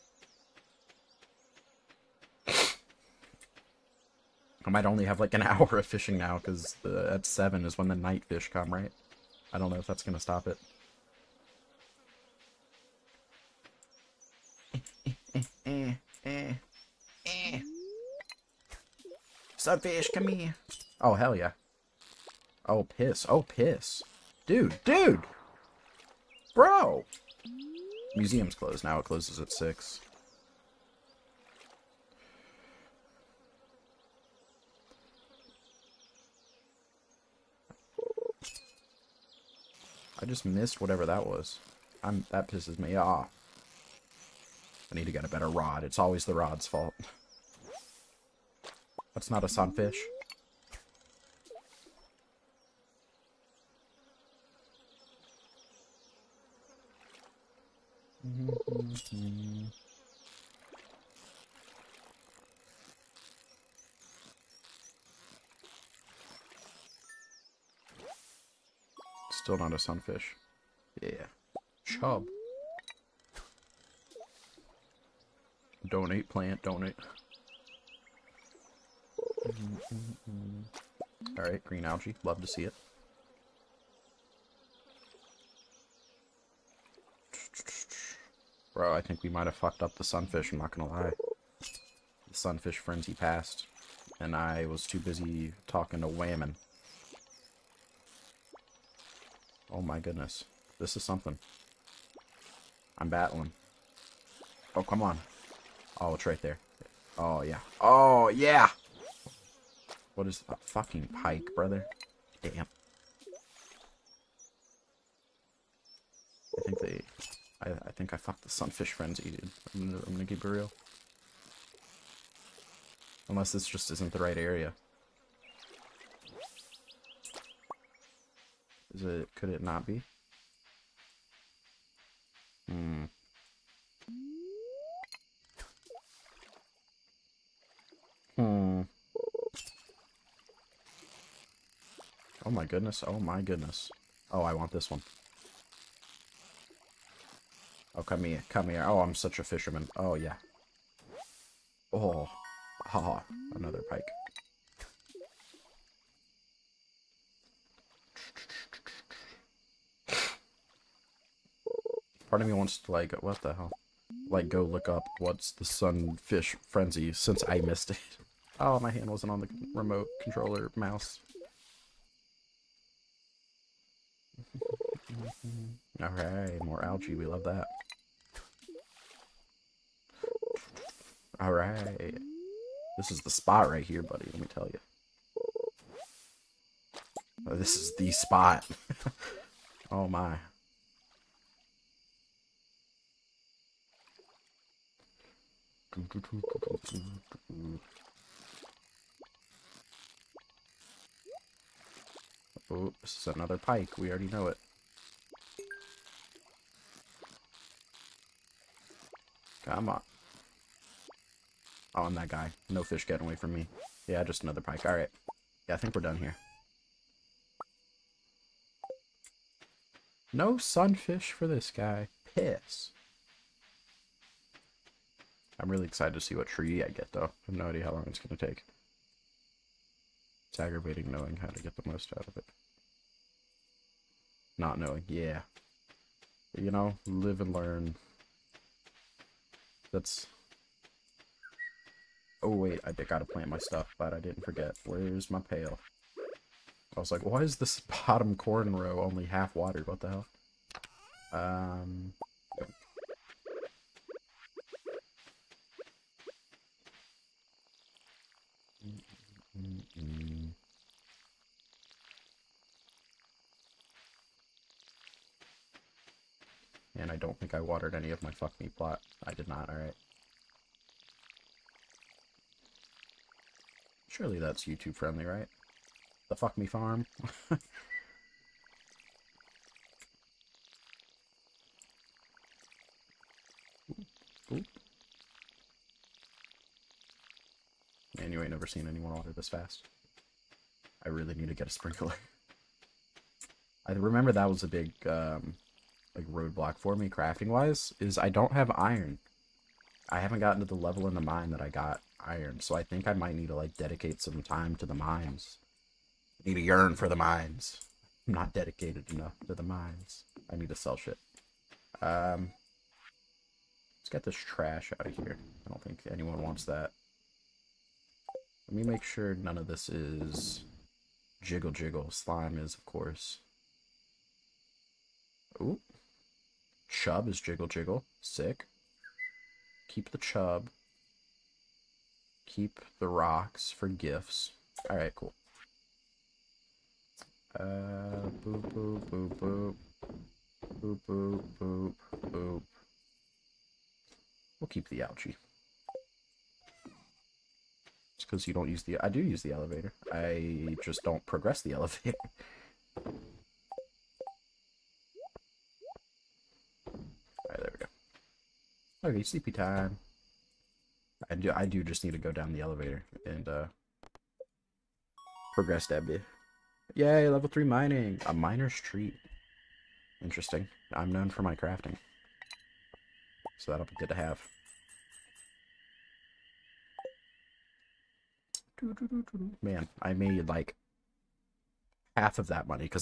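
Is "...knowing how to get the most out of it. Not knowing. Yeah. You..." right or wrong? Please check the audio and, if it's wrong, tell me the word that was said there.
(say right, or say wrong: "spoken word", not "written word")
right.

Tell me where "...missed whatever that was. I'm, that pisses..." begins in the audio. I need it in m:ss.
0:40.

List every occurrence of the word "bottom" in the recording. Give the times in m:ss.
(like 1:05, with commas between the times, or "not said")
4:08.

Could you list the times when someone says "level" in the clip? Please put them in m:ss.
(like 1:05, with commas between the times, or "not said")
5:00, 6:07.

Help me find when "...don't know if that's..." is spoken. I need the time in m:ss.
0:09.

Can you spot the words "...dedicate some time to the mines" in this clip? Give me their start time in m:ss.
5:03.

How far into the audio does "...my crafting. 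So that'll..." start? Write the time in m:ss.
6:11.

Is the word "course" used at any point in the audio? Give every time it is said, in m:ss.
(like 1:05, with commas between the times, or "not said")
5:22.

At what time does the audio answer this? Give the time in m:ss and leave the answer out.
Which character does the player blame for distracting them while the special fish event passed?
1:36.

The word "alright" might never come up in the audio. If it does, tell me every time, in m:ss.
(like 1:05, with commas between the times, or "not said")
1:21, 2:56, 3:01, 3:34, 4:29, 5:34, 5:57.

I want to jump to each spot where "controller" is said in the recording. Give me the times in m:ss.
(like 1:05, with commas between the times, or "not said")
2:50.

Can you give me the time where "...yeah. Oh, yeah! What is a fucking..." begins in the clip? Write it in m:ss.
1:47.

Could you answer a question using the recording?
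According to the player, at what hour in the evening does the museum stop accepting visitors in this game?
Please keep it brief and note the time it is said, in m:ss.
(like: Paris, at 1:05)
6, at 0:28.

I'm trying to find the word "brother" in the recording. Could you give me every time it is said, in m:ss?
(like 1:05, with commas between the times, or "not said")
1:51.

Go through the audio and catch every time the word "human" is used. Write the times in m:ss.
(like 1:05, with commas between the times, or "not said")
not said.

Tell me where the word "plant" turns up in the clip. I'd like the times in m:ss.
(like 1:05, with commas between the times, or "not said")
1:16, 4:03.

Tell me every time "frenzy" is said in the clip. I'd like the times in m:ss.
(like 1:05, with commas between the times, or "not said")
1:32, 1:58, 2:46.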